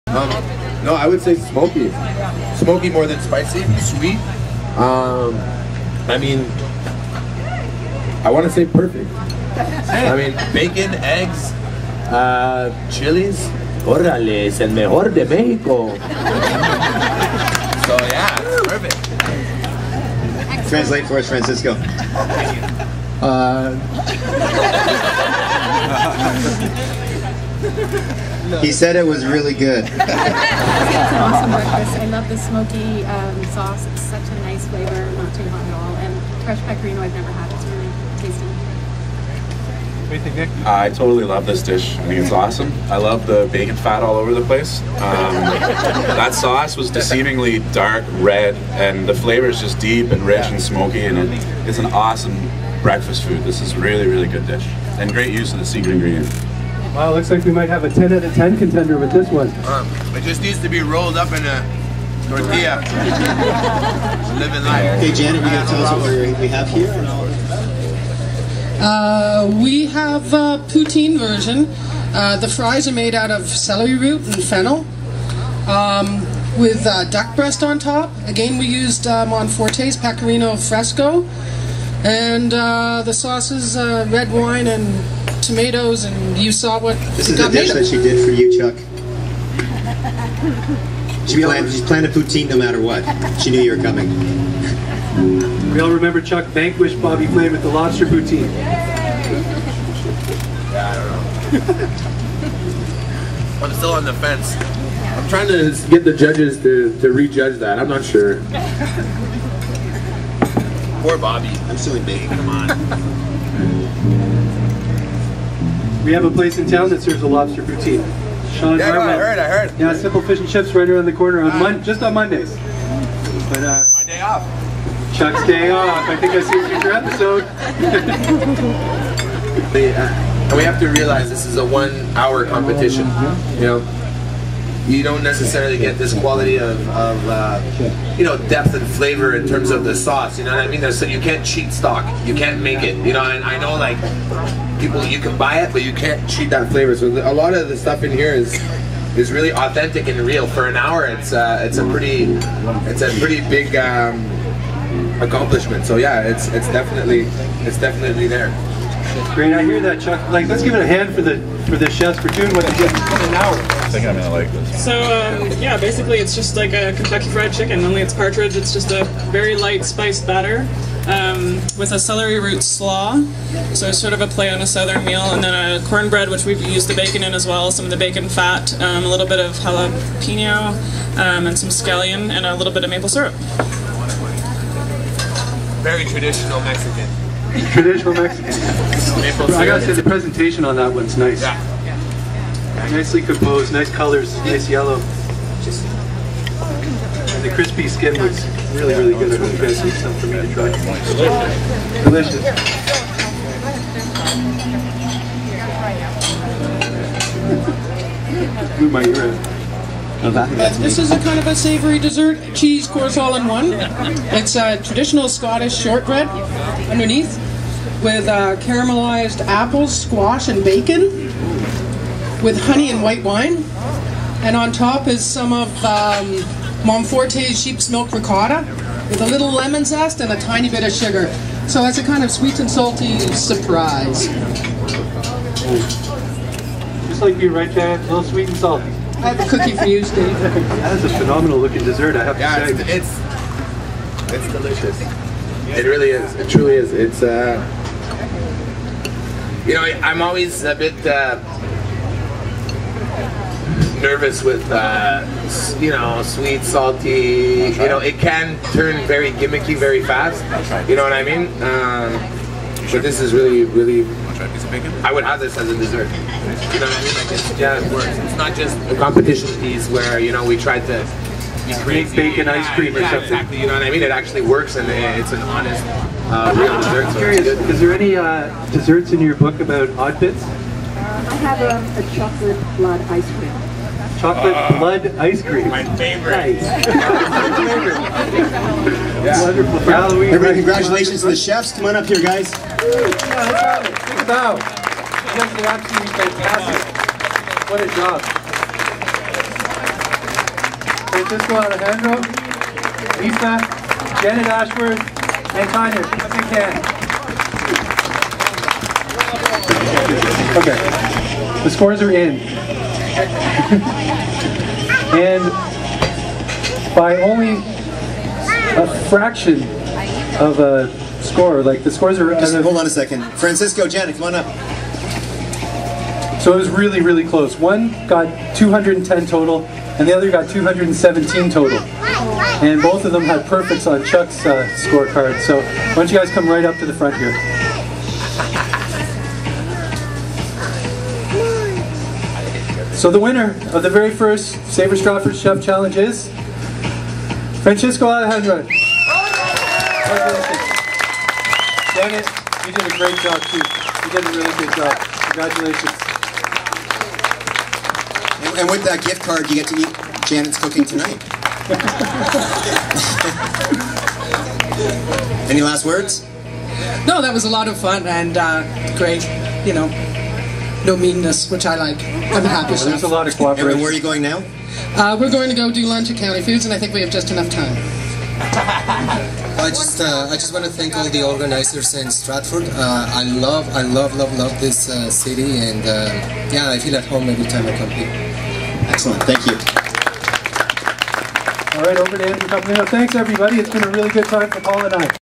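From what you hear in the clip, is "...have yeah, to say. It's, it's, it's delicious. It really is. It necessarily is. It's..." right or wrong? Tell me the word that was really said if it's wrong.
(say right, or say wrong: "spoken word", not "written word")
wrong: "truly", not "necessarily".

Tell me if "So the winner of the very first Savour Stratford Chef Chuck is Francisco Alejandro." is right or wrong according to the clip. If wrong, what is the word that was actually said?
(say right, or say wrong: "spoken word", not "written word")
wrong: "Challenge", not "Chuck".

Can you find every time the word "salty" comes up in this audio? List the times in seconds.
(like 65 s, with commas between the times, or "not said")
232 s, 238 s, 256 s.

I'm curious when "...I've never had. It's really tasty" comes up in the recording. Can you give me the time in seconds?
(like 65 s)
37 s.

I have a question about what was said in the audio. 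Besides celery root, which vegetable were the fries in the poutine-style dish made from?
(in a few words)
fennel.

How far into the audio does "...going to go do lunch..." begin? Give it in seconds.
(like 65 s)
375 s.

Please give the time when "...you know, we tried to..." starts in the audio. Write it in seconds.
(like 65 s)
270 s.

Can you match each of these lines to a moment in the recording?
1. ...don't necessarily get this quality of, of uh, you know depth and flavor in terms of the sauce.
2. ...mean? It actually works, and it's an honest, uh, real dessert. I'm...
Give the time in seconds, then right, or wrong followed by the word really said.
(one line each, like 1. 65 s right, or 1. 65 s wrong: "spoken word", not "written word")
1. 135 s right
2. 273 s right.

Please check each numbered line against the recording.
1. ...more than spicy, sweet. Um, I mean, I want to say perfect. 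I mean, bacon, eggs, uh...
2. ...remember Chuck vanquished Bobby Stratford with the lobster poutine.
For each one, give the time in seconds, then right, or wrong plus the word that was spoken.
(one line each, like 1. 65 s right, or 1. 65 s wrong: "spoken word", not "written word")
1. 2 s right
2. 95 s wrong: "Flay", not "Stratford".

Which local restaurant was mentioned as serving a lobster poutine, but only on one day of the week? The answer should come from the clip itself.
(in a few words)
Simple Fish and Chips.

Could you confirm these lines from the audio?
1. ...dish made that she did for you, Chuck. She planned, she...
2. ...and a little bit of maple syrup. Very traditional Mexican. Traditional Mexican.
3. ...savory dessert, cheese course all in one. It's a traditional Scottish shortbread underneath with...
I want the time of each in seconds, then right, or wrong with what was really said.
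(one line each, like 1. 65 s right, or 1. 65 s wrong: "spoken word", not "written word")
1. 87 s right
2. 182 s right
3. 211 s right.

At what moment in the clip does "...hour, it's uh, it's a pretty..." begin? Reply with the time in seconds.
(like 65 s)
150 s.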